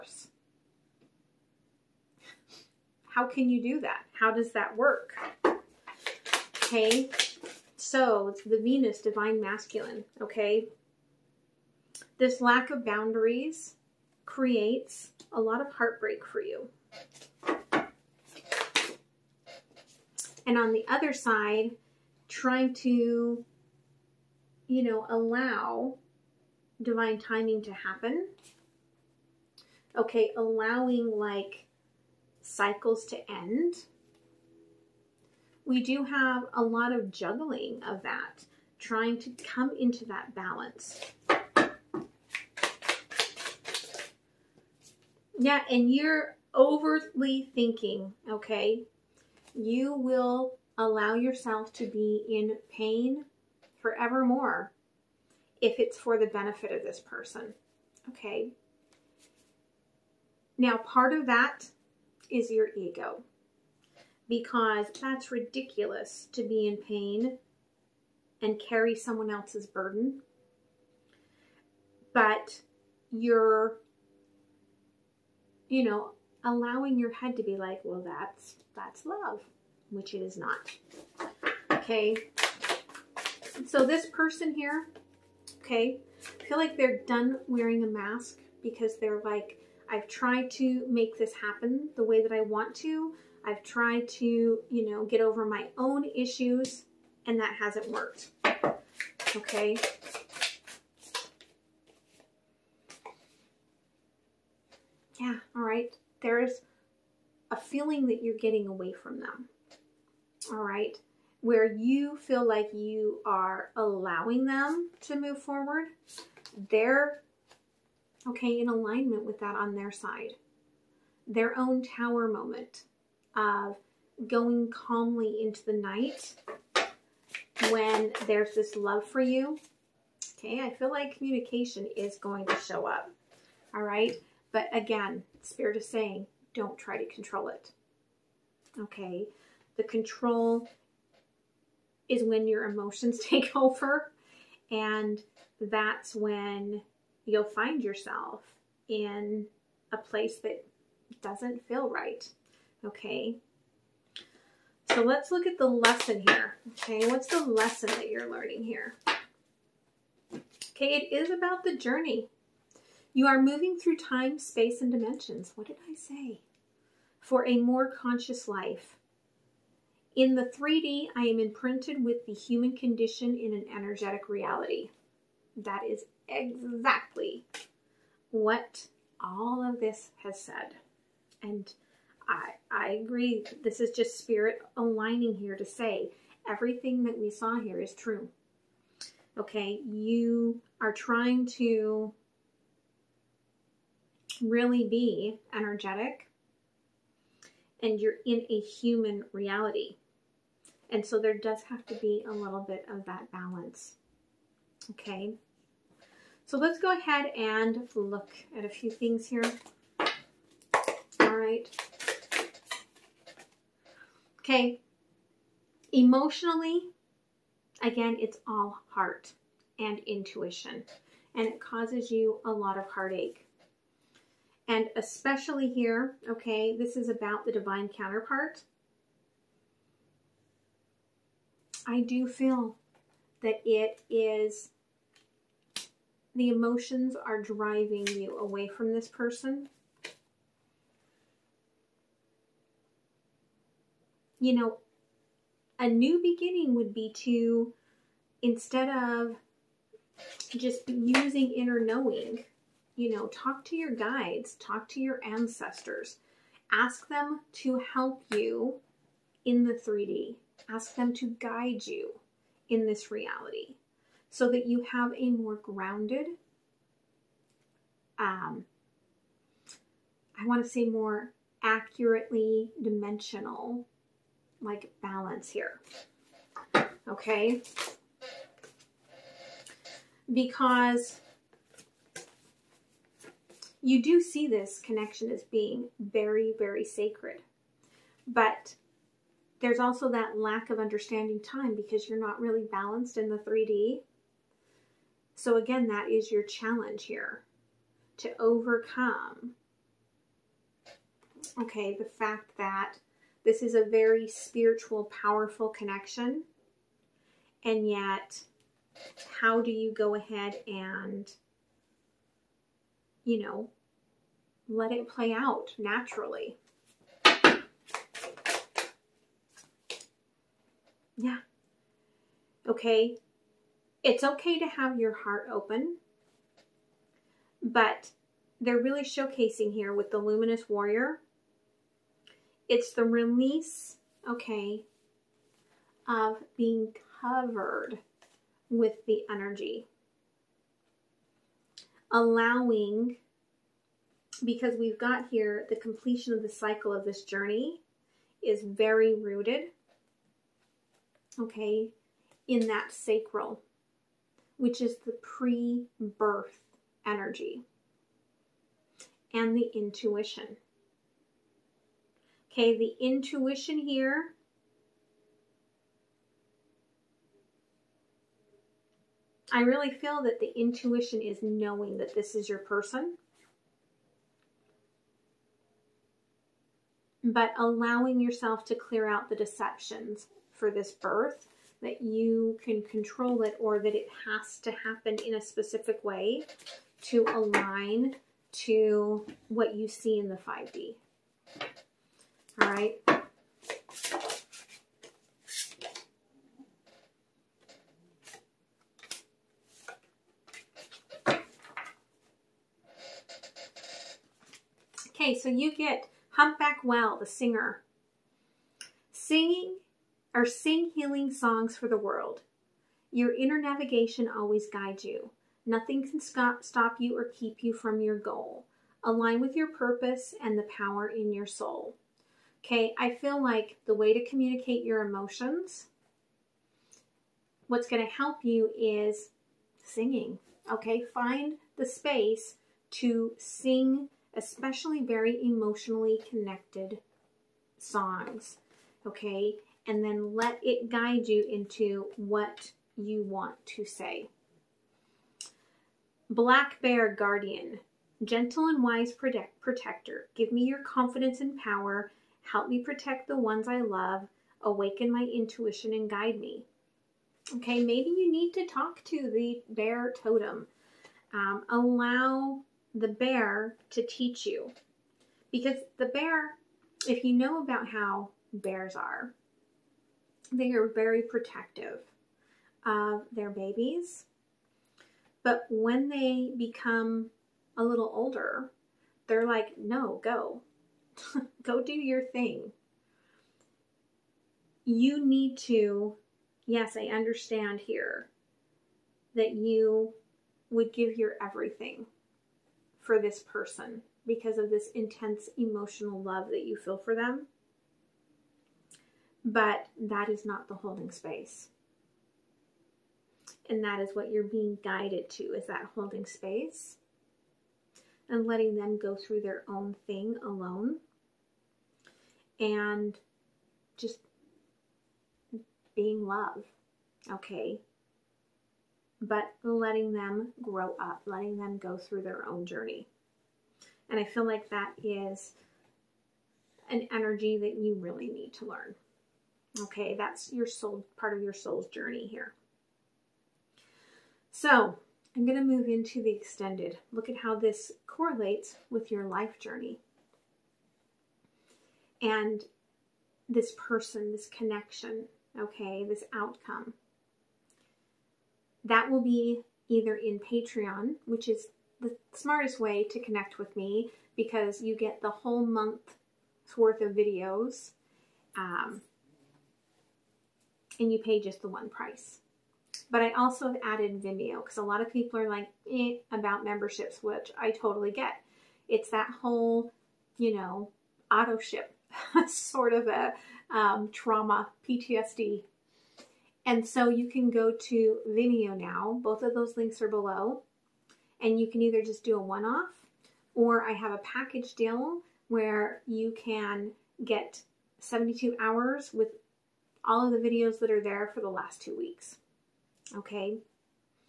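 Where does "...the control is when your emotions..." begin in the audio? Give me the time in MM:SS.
02:19.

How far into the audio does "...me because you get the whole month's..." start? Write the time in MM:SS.
09:13.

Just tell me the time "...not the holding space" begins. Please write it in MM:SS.
08:20.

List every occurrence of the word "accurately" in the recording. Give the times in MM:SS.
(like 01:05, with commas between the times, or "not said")
04:31.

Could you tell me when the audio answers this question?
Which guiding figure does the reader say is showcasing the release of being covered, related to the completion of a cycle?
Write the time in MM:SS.
05:30.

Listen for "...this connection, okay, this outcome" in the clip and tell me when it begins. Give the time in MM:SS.
09:04.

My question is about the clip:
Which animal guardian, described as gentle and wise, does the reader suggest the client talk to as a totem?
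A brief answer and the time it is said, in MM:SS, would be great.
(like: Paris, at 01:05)
Black Bear, at 07:26.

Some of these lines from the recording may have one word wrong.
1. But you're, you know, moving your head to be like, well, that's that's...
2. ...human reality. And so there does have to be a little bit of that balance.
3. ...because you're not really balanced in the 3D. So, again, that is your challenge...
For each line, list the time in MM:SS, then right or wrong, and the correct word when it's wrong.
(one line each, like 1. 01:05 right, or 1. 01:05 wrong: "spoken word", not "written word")
1. 01:12 wrong: "allowing", not "moving"
2. 03:18 right
3. 04:51 right.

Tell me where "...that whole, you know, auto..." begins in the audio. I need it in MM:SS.
09:29.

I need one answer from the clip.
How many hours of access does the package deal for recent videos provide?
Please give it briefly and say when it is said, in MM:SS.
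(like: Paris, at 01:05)
72, at 09:47.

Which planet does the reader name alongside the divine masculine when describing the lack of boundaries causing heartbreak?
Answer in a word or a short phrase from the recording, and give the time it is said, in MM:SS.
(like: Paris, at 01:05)
Venus, at 00:08.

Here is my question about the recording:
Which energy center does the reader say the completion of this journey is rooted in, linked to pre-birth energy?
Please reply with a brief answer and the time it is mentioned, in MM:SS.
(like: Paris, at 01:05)
Sacral, at 05:52.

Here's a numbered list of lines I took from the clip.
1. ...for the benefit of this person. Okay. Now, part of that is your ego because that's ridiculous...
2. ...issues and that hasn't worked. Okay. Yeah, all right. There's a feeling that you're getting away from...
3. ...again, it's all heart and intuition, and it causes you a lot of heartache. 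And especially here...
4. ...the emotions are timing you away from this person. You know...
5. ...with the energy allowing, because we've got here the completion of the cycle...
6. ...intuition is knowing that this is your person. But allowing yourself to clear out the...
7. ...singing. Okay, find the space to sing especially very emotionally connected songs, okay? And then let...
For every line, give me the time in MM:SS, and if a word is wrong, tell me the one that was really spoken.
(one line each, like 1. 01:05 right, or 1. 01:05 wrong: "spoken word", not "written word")
1. 00:55 right
2. 01:36 right
3. 03:37 right
4. 03:56 wrong: "driving", not "timing"
5. 05:38 right
6. 06:10 right
7. 07:09 right.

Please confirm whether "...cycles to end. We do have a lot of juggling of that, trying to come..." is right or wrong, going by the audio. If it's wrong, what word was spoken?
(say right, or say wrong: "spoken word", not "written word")
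right.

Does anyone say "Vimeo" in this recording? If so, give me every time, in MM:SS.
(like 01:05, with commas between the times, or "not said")
09:24, 09:38.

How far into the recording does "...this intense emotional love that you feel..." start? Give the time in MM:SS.
08:14.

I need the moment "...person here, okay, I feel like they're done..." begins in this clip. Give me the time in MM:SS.
01:24.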